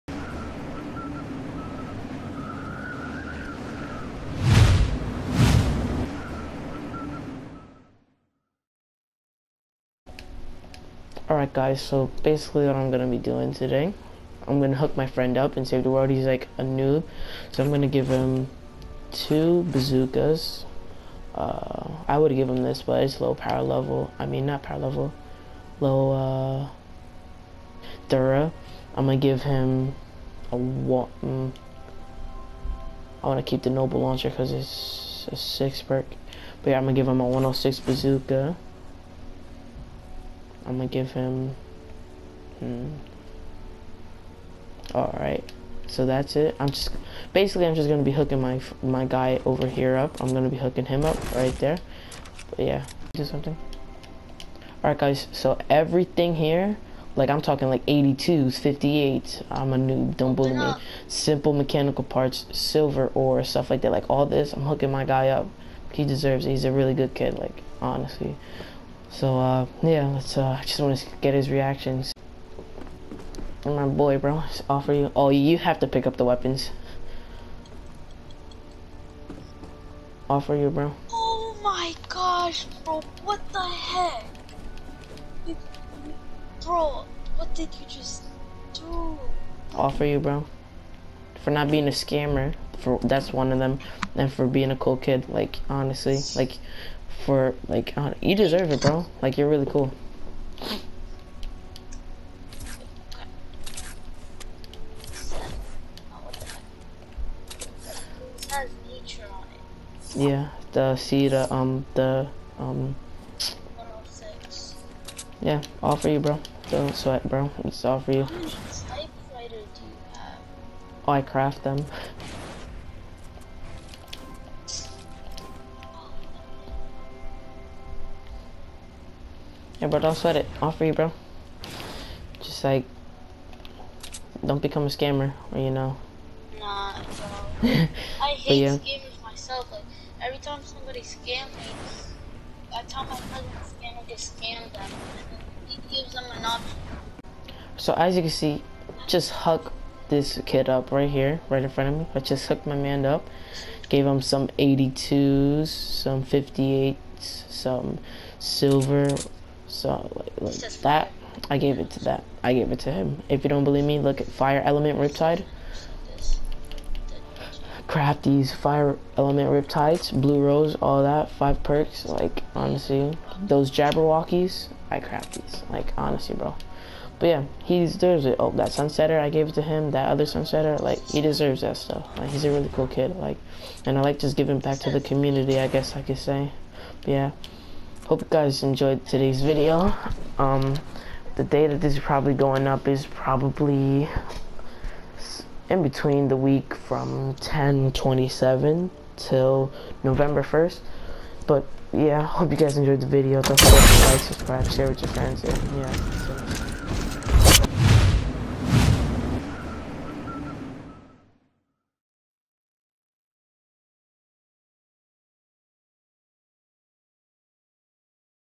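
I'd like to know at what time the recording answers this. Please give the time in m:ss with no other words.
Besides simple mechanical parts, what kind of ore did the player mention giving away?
1:02.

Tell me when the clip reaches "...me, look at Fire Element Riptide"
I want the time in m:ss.
2:43.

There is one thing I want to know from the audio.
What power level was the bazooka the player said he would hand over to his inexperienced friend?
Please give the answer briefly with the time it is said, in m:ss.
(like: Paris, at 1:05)
106, at 0:37.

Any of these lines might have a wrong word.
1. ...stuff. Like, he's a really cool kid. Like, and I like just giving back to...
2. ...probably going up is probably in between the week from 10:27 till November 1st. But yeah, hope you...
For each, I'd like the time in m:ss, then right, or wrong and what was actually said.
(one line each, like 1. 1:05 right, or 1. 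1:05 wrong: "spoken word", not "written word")
1. 3:01 right
2. 3:11 right.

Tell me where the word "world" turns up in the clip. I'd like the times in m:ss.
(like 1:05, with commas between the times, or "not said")
0:15.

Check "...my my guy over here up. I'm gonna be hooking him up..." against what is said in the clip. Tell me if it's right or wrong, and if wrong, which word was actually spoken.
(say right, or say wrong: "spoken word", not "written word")
right.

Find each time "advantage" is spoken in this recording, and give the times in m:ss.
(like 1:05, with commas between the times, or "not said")
not said.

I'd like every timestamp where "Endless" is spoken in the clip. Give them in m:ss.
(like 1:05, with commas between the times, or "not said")
not said.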